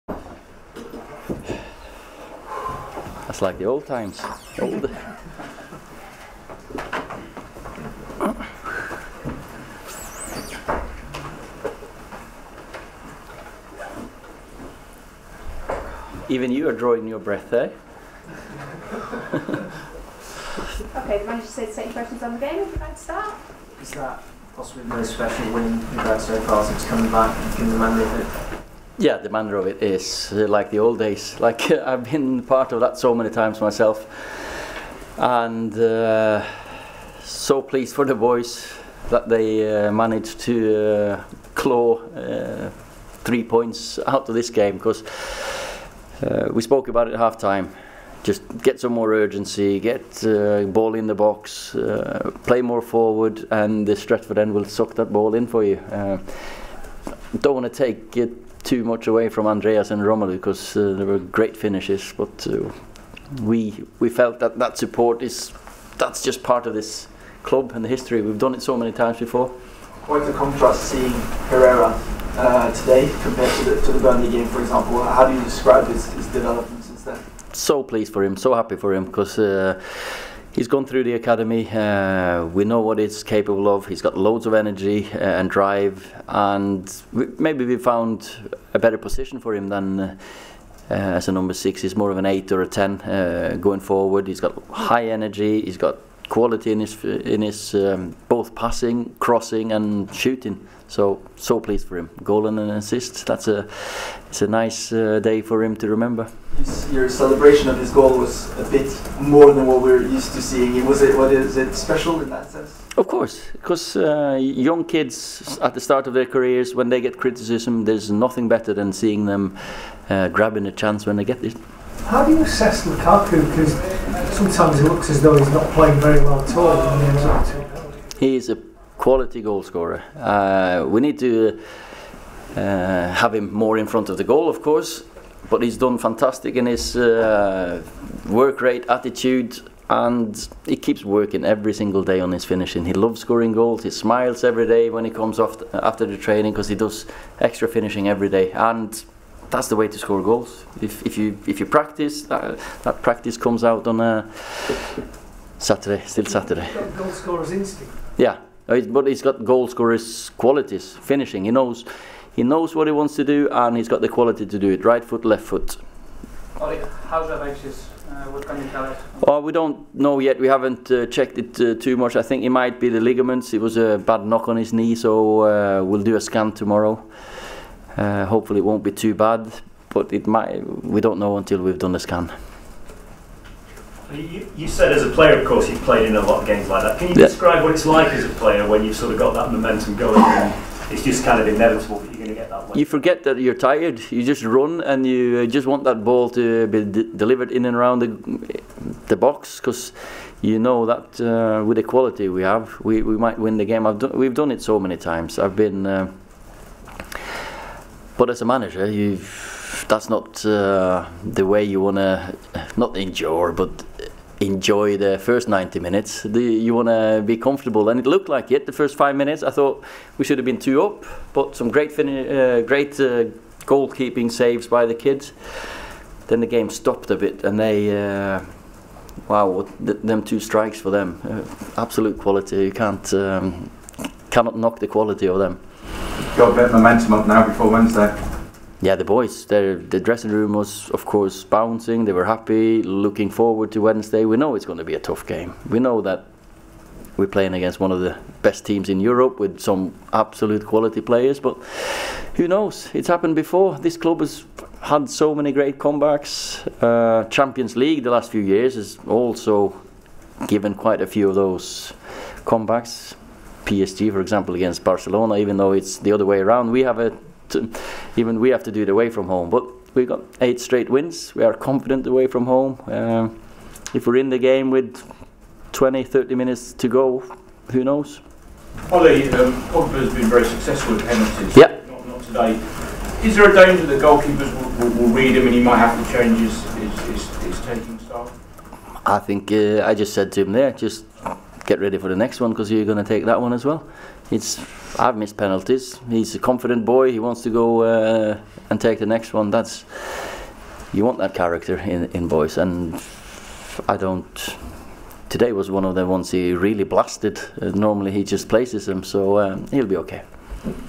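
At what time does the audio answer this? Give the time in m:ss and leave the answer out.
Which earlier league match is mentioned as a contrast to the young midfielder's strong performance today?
1:13.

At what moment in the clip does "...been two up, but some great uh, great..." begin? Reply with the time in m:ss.
3:40.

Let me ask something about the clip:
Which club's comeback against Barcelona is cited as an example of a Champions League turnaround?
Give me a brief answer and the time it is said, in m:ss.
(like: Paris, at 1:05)
PSG, at 4:23.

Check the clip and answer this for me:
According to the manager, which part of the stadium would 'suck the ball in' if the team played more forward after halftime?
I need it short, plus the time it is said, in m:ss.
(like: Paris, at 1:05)
Stretford End, at 0:53.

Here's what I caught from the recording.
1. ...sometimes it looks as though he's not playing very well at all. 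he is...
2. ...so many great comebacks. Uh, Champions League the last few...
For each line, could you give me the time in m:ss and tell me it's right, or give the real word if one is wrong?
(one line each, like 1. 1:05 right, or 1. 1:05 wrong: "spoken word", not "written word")
1. 2:04 right
2. 4:15 right.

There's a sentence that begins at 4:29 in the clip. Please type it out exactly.
But we got eight straight wins.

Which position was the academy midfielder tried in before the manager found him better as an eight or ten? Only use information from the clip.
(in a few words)
number six.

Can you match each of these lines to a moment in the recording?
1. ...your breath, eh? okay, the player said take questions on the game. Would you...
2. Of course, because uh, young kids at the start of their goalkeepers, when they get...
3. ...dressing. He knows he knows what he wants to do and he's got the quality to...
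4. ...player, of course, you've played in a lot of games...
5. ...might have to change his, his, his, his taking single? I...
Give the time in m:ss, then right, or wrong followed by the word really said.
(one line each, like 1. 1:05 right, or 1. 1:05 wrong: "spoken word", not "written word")
1. 0:17 wrong: "manager", not "player"
2. 1:52 wrong: "careers", not "goalkeepers"
3. 2:41 wrong: "finishing", not "dressing"
4. 3:05 right
5. 4:45 wrong: "style", not "single".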